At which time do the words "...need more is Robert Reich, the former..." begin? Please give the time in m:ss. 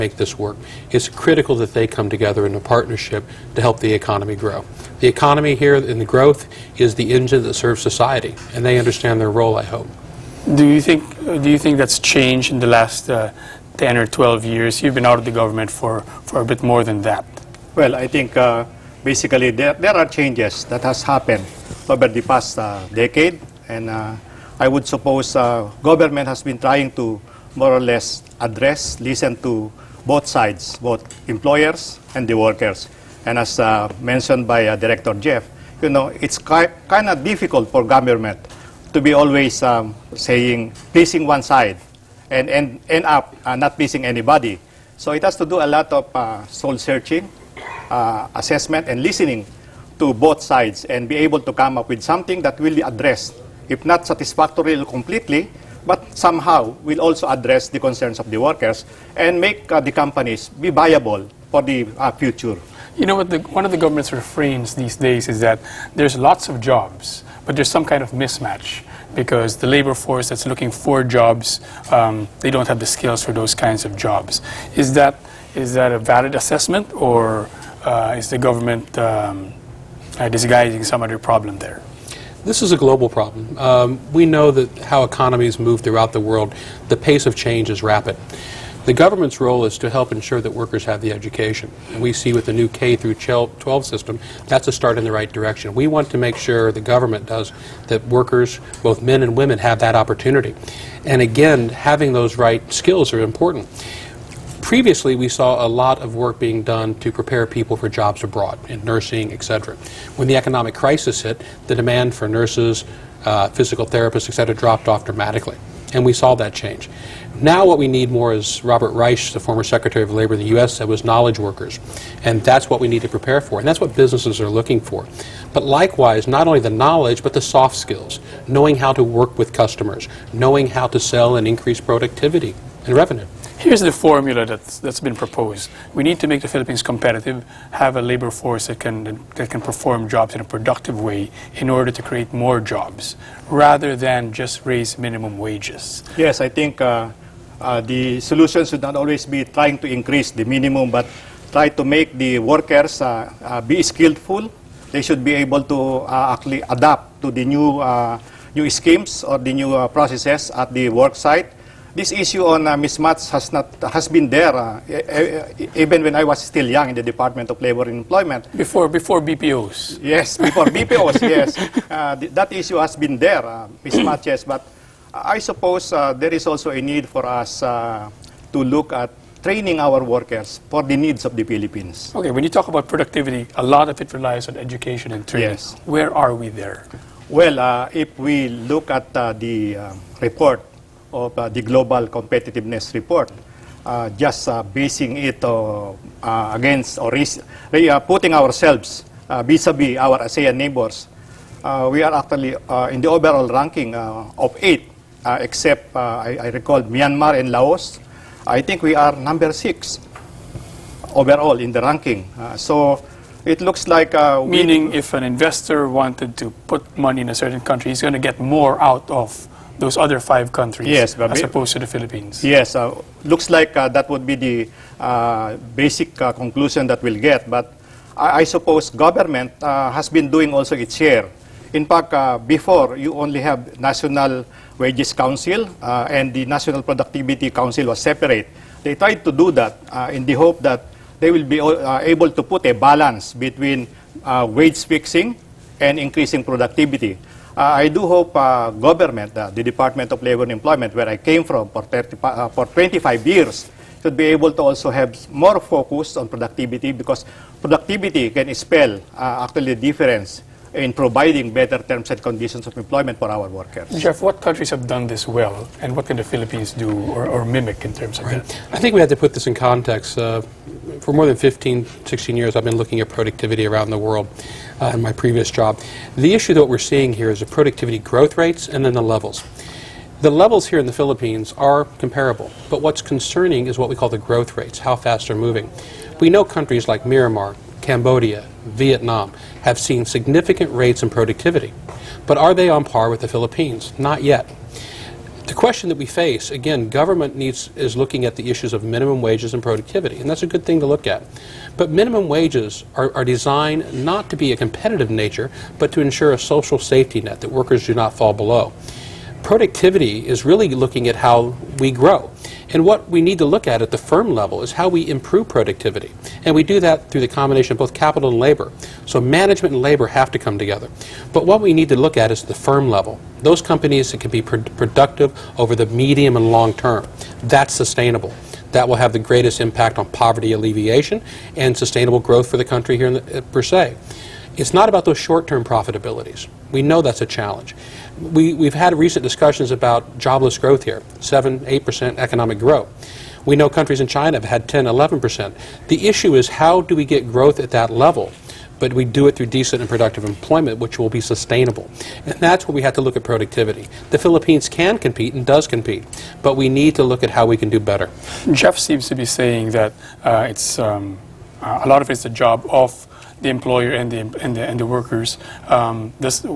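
1:57.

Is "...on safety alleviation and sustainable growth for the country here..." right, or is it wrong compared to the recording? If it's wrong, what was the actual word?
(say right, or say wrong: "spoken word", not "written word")
wrong: "poverty", not "safety".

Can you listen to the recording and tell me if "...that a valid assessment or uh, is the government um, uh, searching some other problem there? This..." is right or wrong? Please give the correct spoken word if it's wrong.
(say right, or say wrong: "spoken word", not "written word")
wrong: "disguising", not "searching".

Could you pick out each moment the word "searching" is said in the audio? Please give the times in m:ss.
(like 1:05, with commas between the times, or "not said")
0:46.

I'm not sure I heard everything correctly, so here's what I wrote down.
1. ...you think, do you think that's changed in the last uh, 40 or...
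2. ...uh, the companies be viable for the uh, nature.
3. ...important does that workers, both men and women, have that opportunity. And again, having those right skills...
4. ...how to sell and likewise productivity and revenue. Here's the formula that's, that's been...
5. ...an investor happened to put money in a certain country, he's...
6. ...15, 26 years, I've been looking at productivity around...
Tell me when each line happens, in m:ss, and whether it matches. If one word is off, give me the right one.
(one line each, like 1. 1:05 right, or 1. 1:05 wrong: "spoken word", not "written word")
1. 0:10 wrong: "10", not "40"
2. 0:59 wrong: "future", not "nature"
3. 1:36 wrong: "government", not "important"
4. 2:10 wrong: "increase", not "likewise"
5. 3:35 wrong: "wanted", not "happened"
6. 4:31 wrong: "16", not "26".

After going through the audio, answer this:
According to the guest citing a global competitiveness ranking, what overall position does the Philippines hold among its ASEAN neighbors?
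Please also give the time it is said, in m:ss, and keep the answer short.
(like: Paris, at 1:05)
6, at 3:29.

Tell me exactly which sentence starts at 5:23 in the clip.
Those companies that can be pr productive over the medium and long term.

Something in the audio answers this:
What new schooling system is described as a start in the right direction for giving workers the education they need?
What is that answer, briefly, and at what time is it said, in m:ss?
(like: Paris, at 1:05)
K through 12, at 1:32.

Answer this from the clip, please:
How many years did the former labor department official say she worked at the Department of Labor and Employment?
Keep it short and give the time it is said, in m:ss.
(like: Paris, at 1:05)
25, at 4:12.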